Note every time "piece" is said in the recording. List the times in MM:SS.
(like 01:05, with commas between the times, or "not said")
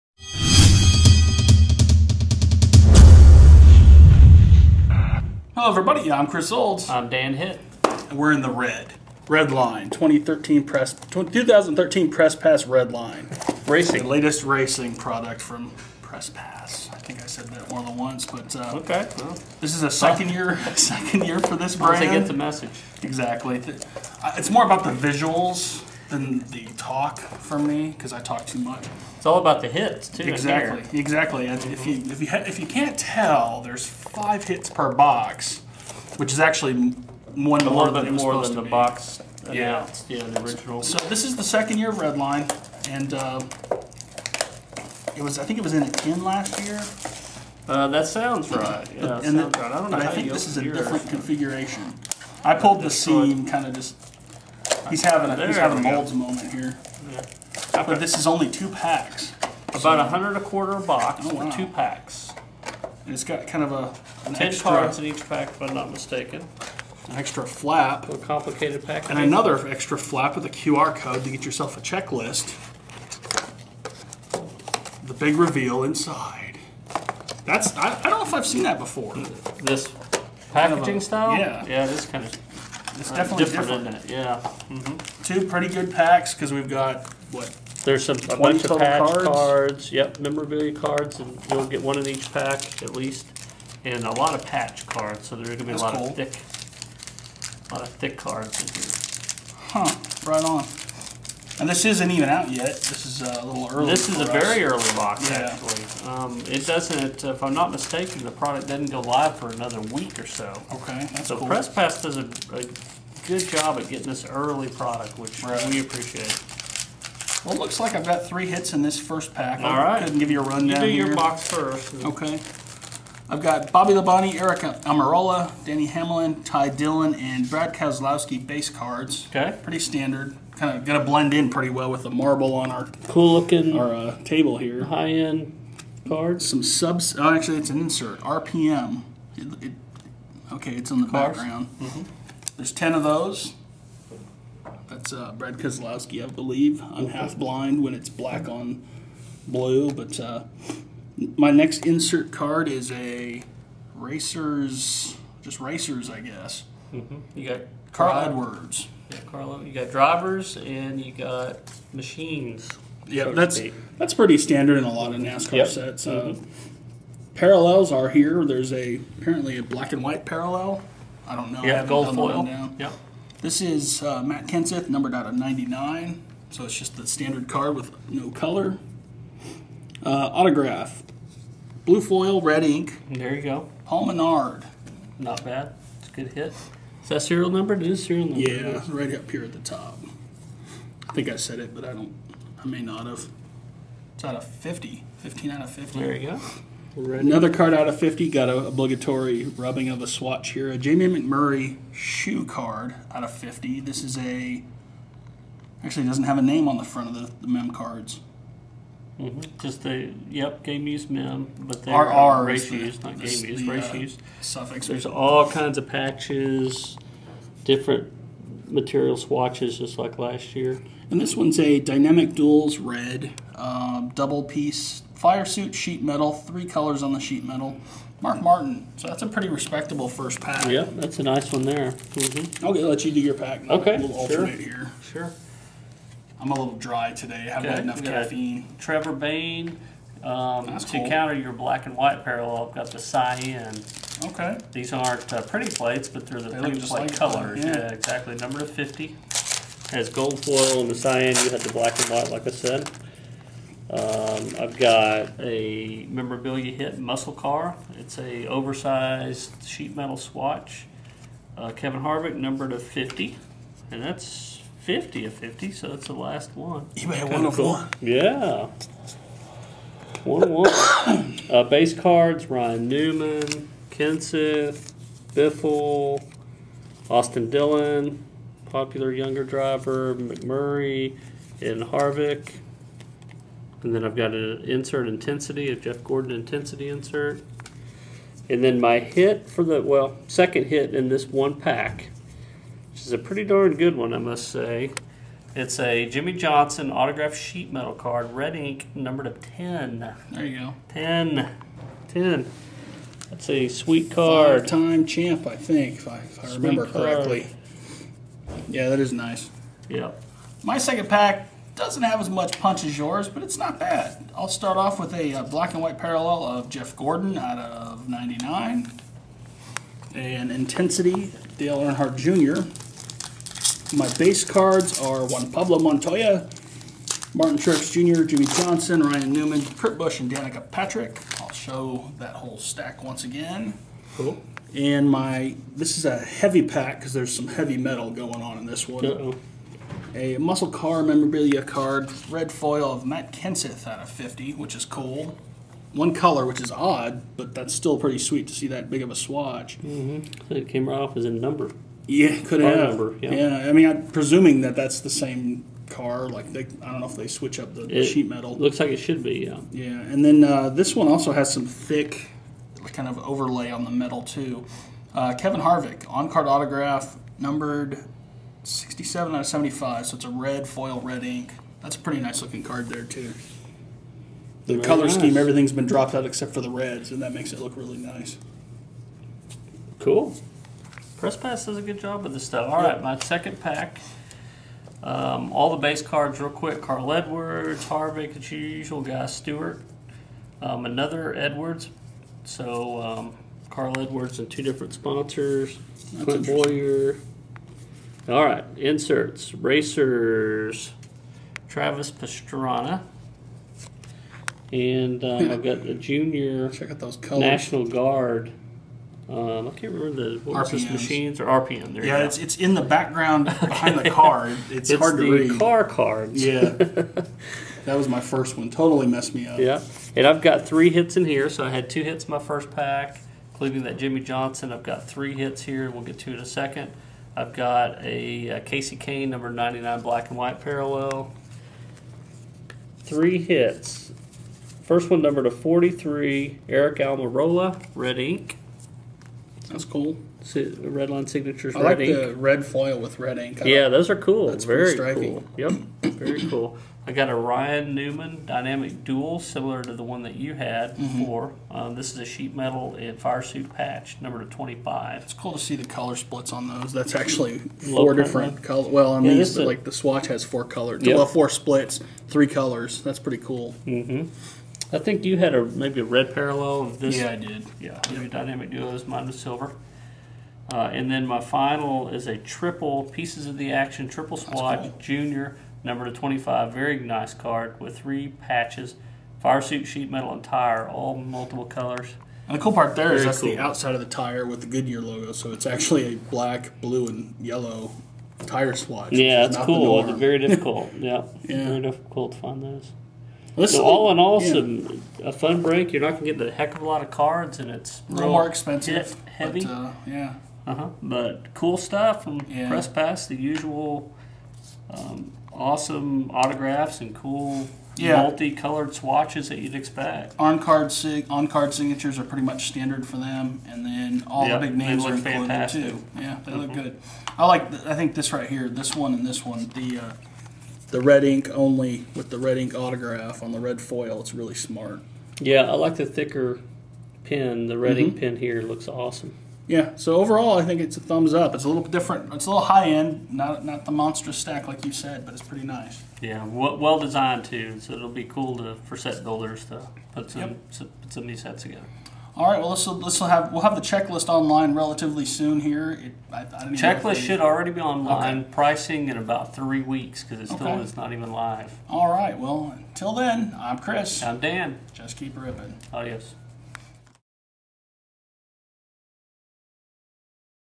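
03:44, 07:53.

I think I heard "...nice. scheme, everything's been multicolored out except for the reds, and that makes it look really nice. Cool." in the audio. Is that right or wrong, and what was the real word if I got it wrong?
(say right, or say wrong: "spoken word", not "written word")
wrong: "dropped", not "multicolored".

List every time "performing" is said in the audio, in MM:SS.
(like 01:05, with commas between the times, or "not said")
not said.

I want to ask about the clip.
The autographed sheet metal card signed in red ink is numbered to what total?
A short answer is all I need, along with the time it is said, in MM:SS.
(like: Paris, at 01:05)
10, at 04:58.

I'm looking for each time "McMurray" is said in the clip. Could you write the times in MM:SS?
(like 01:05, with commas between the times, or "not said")
03:21, 04:40.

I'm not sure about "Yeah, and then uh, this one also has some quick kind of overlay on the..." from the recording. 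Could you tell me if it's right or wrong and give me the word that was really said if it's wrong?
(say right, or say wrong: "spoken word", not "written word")
wrong: "thick", not "quick".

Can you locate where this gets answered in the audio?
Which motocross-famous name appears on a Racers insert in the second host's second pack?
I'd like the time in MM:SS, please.
06:41.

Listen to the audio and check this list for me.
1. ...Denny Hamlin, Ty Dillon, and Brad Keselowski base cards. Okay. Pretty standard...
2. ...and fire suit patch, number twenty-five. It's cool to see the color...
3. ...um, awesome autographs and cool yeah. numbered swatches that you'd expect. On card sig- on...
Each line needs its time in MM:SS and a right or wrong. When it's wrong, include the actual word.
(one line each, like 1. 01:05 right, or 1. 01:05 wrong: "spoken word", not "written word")
1. 02:05 right
2. 07:32 right
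3. 08:24 wrong: "multicolored", not "numbered".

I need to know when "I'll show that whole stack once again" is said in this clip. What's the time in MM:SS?
05:31.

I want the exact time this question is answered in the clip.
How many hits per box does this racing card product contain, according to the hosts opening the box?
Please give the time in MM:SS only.
00:34.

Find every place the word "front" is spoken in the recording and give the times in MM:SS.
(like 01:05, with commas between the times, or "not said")
03:26.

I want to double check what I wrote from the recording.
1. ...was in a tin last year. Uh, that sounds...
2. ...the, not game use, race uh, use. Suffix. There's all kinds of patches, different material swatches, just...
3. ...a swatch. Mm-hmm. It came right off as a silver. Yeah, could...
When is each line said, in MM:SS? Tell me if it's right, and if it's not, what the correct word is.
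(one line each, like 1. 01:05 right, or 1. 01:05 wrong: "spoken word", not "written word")
1. 00:45 right
2. 03:32 right
3. 05:49 wrong: "number", not "silver".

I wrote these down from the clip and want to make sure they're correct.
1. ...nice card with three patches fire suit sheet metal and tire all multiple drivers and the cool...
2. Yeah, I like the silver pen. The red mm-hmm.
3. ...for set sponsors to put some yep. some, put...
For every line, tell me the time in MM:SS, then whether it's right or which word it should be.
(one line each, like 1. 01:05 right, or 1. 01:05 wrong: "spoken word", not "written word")
1. 07:56 wrong: "colors", not "drivers"
2. 08:45 wrong: "thicker", not "silver"
3. 08:58 wrong: "builders", not "sponsors".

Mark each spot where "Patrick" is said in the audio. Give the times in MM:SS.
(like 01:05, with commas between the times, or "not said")
05:30.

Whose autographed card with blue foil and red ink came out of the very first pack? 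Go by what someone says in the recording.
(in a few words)
Paul Menard.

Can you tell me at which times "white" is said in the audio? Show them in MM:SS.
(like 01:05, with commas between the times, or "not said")
02:50, 04:01, 04:12, 05:15, 07:10.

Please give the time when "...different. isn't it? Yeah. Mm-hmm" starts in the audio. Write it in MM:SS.
01:23.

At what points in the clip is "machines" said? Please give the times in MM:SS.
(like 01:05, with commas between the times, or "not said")
02:41, 06:50.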